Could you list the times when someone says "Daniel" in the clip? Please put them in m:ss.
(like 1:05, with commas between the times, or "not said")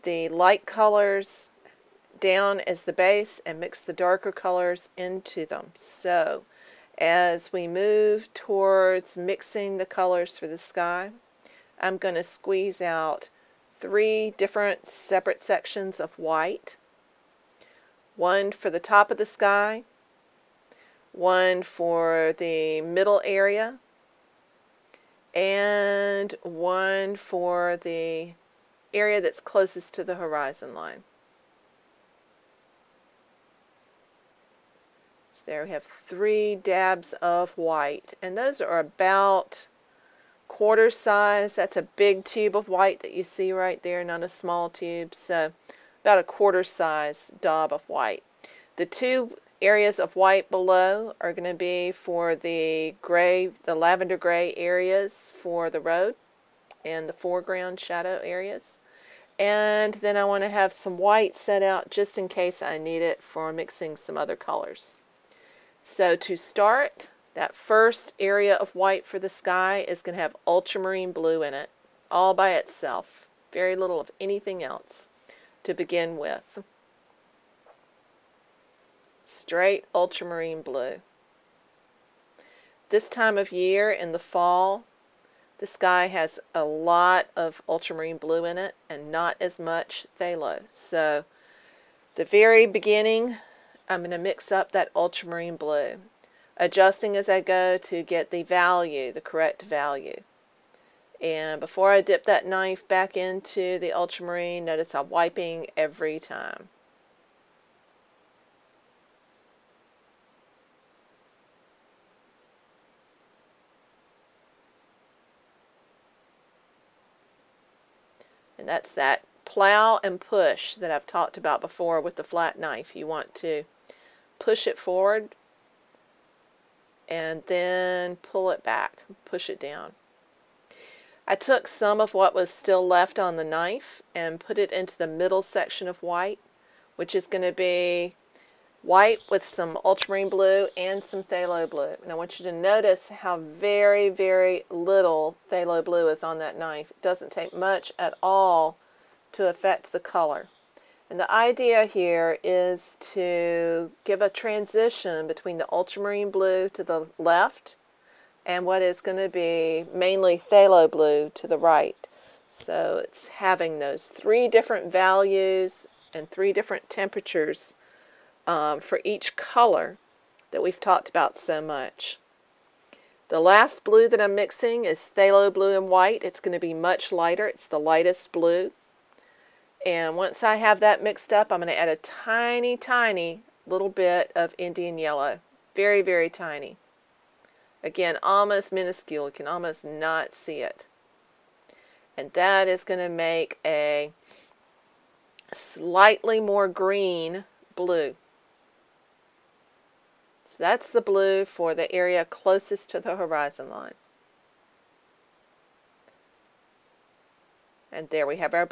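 not said.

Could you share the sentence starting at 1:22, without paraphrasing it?
This time of year in the fall, the sky has a lot of ultramarine blue in it and not as much phthalo.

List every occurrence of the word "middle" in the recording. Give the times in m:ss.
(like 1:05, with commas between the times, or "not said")
0:22, 2:15.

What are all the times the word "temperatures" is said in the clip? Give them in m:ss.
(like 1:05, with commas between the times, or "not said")
2:46.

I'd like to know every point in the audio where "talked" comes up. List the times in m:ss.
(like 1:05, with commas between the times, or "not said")
2:01, 2:50.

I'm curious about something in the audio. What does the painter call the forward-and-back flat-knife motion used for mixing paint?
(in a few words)
plow and push.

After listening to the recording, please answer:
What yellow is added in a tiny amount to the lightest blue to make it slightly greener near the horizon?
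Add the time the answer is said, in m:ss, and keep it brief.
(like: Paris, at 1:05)
Indian yellow, at 3:04.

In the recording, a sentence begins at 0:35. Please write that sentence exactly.
So there we have three dabs of white and those are about quarter size.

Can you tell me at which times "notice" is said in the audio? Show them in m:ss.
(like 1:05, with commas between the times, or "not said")
1:44, 2:22.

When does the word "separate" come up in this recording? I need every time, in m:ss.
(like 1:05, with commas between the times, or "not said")
0:14.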